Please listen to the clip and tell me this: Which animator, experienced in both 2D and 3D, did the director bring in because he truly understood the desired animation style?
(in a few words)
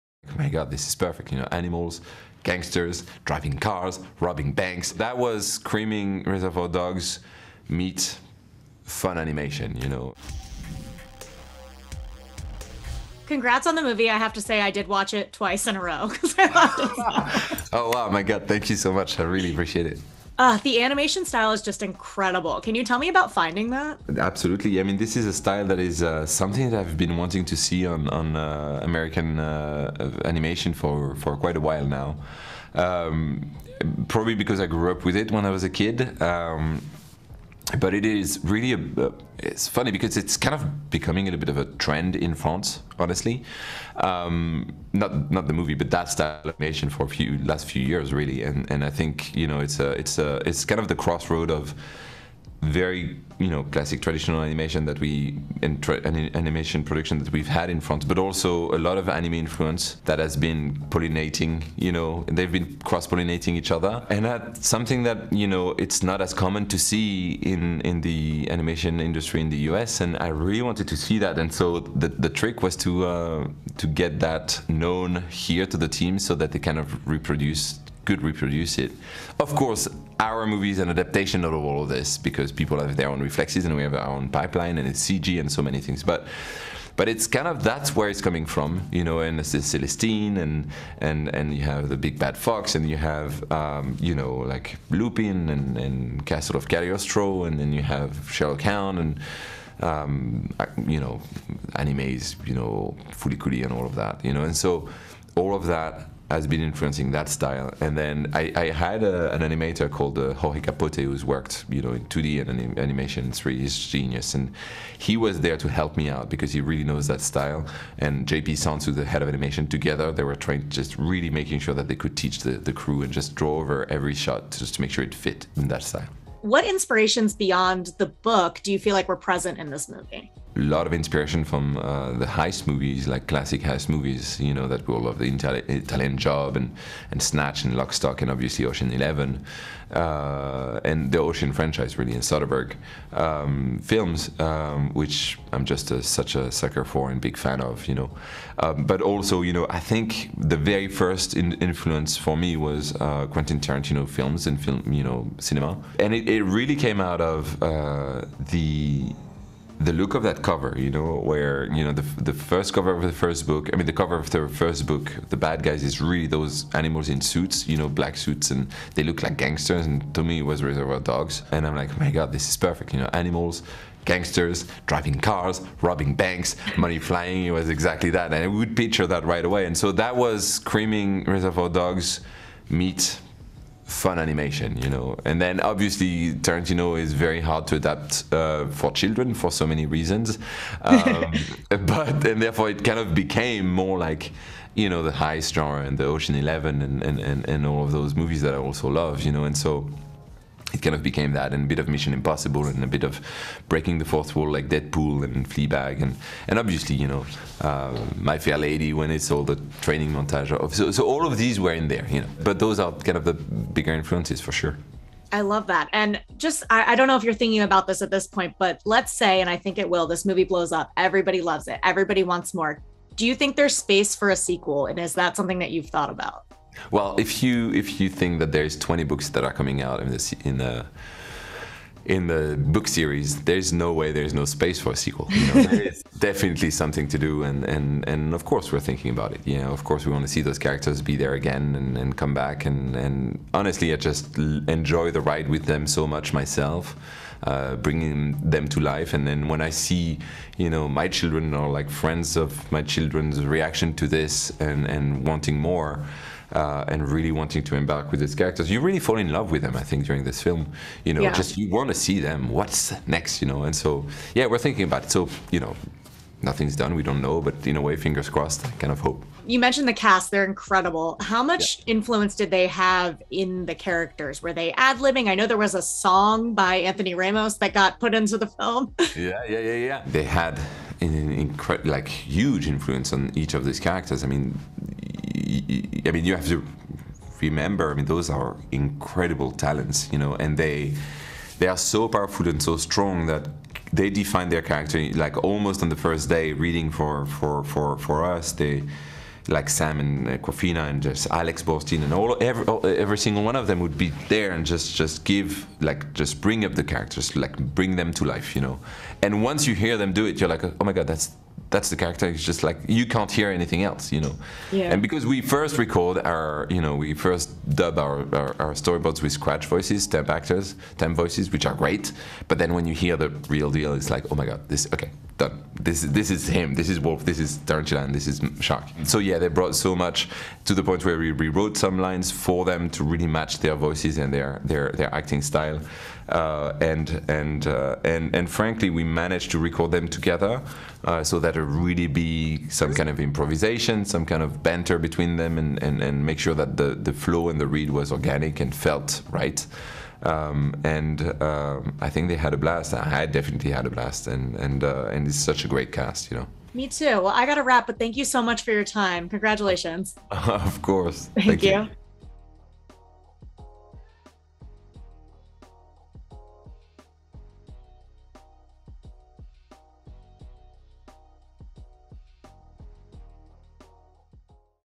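Jorge Capote.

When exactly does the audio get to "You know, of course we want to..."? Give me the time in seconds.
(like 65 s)
239 s.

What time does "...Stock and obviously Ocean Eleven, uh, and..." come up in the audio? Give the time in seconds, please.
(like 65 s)
137 s.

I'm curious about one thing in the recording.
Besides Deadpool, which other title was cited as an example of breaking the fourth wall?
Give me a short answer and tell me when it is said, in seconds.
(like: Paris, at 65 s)
Fleabag, at 205 s.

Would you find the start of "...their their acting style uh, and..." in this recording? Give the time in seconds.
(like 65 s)
334 s.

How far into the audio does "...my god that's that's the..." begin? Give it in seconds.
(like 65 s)
310 s.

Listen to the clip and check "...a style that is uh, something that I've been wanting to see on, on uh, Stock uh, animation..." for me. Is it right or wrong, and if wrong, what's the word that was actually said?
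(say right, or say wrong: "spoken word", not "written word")
wrong: "American", not "Stock".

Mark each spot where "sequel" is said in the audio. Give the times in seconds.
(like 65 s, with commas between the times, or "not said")
224 s, 234 s.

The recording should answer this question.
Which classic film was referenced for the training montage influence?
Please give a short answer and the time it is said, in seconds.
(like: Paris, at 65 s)
My Fair Lady, at 208 s.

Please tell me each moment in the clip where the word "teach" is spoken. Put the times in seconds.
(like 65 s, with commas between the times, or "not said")
122 s.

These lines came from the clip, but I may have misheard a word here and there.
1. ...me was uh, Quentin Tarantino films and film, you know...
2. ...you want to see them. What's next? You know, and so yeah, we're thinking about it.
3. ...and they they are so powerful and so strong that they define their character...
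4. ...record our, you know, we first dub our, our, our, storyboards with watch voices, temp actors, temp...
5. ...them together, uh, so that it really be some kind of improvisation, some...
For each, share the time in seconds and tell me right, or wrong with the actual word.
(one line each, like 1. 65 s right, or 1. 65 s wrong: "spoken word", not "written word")
1. 152 s right
2. 261 s right
3. 290 s right
4. 315 s wrong: "scratch", not "watch"
5. 339 s right.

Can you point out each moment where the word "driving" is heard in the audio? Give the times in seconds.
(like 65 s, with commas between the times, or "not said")
3 s, 174 s.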